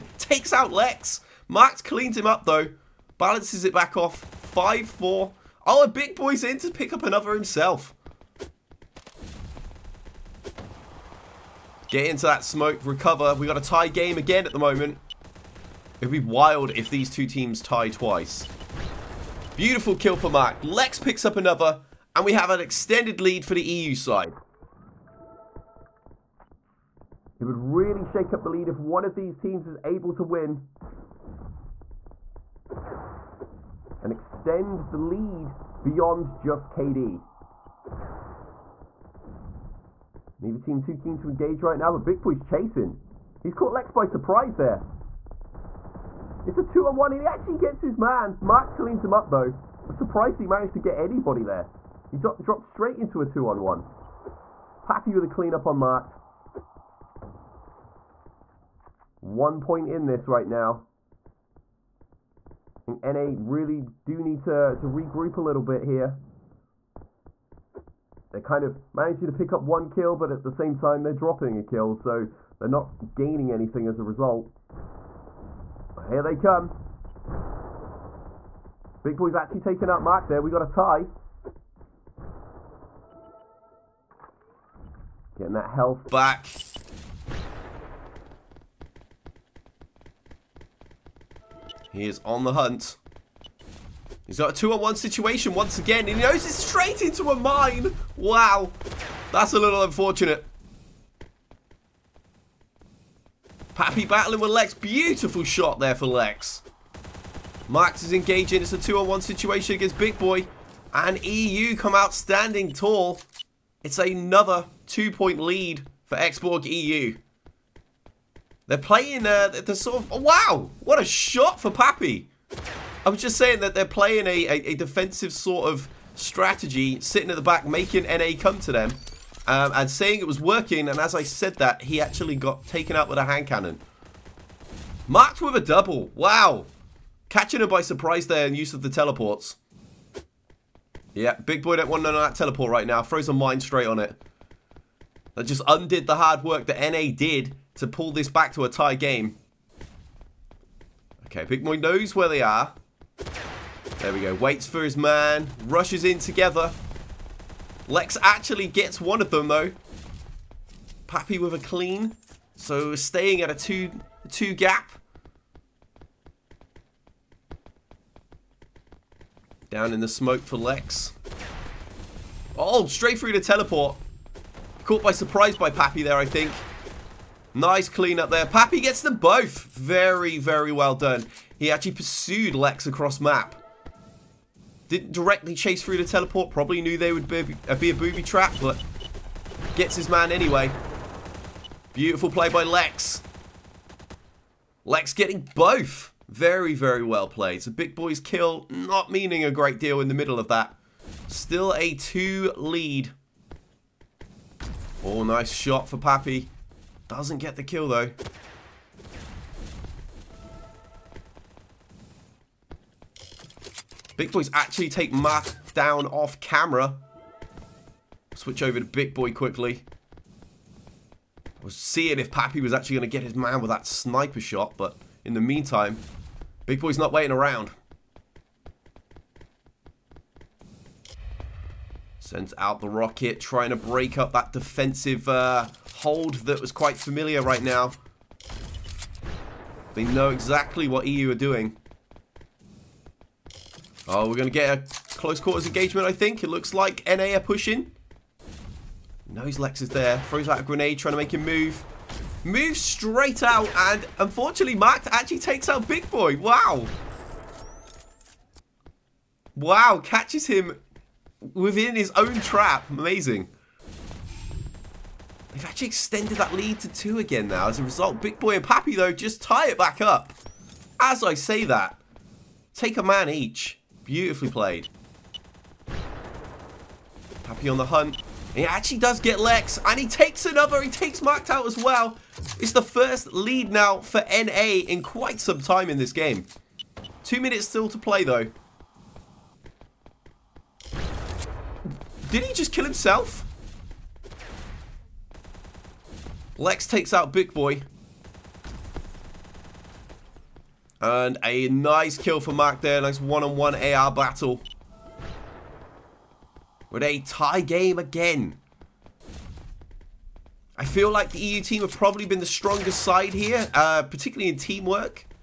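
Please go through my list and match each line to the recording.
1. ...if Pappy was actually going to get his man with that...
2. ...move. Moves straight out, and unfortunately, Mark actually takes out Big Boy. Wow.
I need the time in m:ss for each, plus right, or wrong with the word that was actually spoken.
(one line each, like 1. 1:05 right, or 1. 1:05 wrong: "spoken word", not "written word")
1. 3:42 right
2. 4:11 right.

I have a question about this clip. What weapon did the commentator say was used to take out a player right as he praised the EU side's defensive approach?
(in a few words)
hand cannon.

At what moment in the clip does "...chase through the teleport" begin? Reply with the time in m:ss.
3:05.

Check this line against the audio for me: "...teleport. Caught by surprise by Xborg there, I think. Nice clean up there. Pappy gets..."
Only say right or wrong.
wrong.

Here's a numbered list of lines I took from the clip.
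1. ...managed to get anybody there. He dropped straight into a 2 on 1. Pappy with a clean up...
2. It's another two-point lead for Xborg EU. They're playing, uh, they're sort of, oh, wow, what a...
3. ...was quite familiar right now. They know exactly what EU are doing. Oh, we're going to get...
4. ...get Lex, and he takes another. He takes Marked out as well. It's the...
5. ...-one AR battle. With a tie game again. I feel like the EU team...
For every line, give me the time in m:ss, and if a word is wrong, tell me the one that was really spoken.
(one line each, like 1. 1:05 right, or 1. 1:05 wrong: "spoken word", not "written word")
1. 0:50 right
2. 1:53 right
3. 3:56 right
4. 4:39 right
5. 5:03 right.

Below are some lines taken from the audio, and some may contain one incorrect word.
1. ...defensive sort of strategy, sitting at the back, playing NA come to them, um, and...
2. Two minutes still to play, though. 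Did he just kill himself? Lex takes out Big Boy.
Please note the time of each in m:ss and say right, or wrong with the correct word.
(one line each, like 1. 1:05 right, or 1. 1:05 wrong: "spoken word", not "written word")
1. 2:04 wrong: "making", not "playing"
2. 4:47 right.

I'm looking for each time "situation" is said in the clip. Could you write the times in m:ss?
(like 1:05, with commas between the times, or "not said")
1:34, 1:49.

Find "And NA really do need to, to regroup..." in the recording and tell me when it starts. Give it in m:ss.
1:02.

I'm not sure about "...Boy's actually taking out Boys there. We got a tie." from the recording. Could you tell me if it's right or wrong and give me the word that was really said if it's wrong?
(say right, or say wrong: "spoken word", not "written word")
wrong: "Mark", not "Boys".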